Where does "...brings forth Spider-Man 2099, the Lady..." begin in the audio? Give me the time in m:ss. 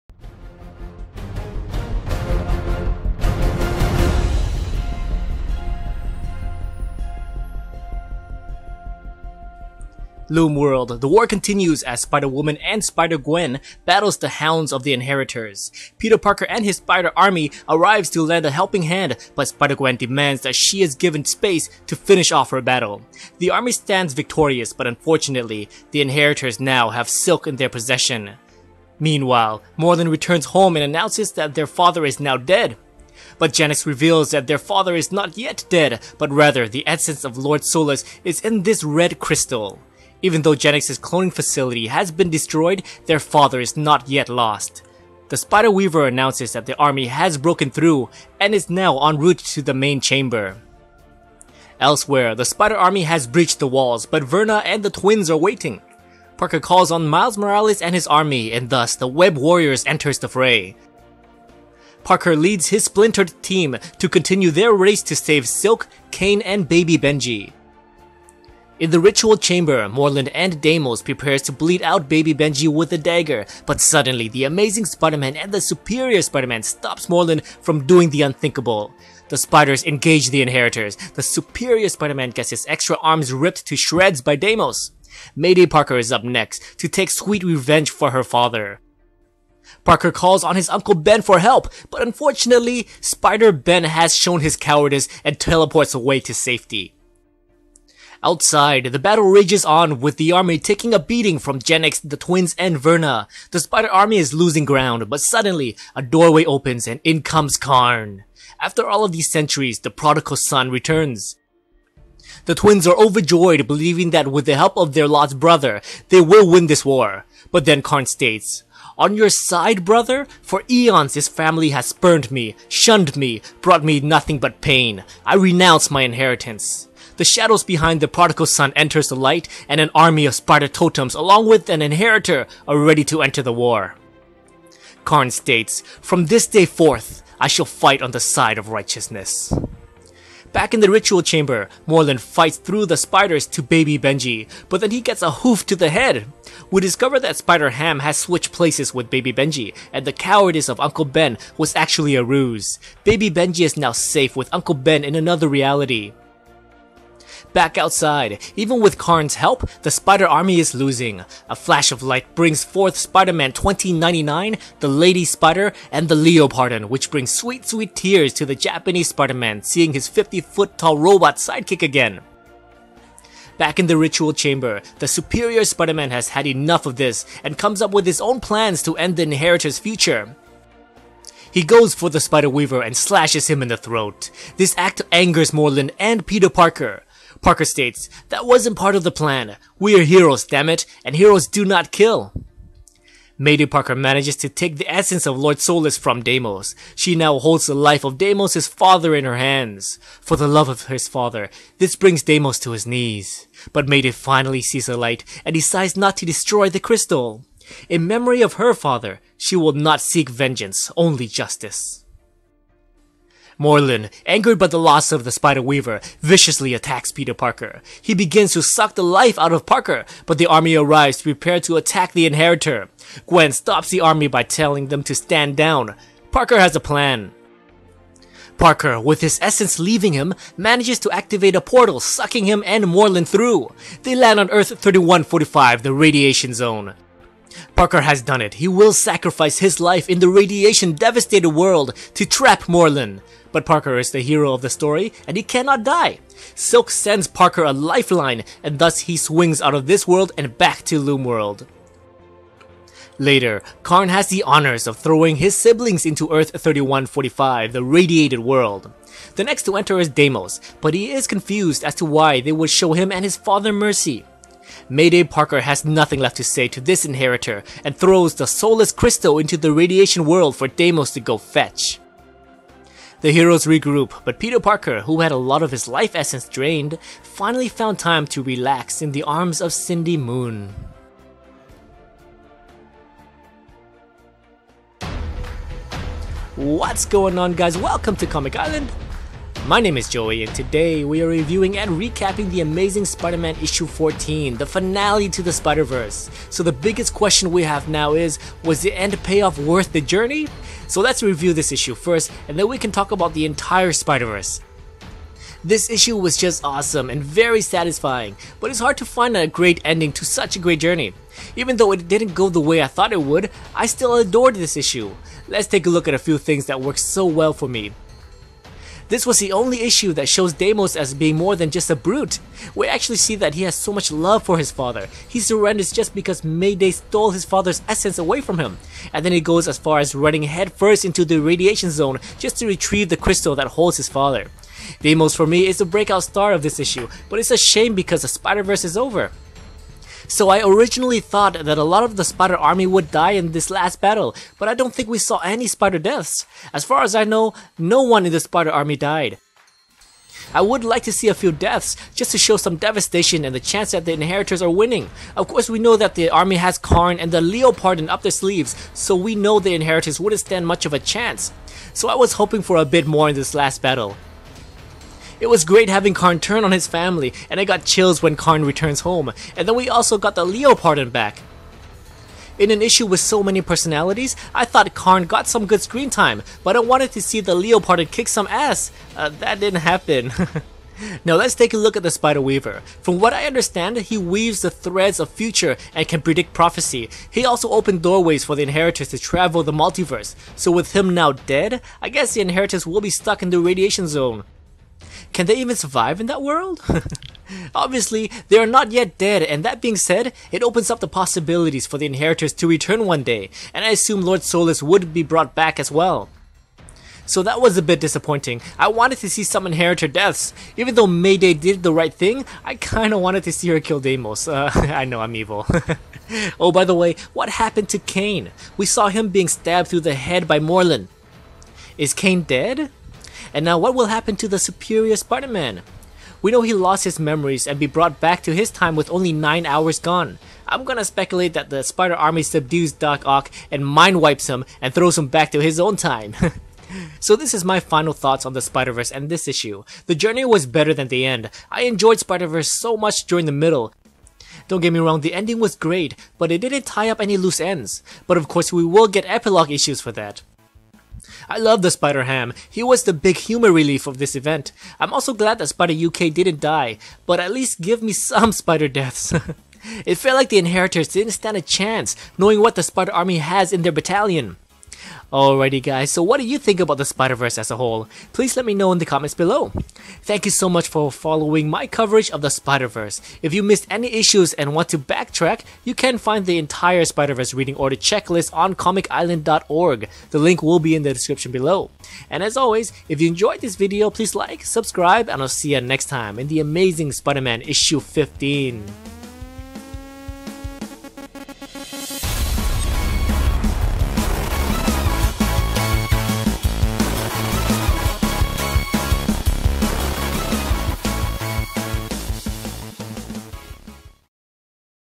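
2:42.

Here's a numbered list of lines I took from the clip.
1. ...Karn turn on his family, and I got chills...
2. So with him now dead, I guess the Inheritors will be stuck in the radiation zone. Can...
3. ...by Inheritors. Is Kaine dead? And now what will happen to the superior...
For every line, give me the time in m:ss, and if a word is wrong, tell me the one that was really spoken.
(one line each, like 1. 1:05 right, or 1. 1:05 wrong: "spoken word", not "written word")
1. 6:06 right
2. 6:30 right
3. 7:00 wrong: "Morlun", not "Inheritors".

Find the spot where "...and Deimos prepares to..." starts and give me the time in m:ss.
1:10.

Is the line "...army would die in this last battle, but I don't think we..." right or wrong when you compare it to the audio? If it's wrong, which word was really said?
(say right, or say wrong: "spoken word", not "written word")
right.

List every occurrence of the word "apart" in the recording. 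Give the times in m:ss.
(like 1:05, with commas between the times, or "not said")
not said.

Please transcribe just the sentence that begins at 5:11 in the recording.
Even though it didn't go the way I thought it would, I still adored this issue.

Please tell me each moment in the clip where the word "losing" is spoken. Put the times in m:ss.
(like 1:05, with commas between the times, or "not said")
1:44, 2:40.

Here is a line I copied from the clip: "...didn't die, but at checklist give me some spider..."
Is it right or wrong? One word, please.
wrong.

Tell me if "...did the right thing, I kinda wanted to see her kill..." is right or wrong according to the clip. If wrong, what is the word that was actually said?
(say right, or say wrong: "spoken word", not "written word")
right.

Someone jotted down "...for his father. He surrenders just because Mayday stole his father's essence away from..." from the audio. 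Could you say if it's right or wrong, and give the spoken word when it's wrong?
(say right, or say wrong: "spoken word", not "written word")
right.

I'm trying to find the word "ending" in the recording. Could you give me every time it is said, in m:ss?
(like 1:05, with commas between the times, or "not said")
5:09, 7:25.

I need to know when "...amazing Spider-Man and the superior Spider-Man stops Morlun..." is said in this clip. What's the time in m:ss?
1:14.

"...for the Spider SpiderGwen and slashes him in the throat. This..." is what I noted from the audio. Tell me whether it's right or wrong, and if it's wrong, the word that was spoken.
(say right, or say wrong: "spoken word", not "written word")
wrong: "Weaver", not "SpiderGwen".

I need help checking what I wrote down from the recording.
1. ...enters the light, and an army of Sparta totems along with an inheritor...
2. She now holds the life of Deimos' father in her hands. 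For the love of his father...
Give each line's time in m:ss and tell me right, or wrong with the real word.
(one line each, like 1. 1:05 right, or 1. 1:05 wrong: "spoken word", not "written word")
1. 2:08 right
2. 3:16 right.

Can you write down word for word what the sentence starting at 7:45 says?
Alrighty guys, so what do you think about the Spider-Verse as a whole?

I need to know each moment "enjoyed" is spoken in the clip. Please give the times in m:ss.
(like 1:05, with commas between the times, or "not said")
7:21, 8:03.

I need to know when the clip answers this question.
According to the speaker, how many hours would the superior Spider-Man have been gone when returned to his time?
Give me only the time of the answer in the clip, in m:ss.
7:09.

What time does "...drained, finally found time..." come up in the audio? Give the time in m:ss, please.
4:36.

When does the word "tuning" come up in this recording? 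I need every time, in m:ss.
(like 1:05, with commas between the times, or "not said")
not said.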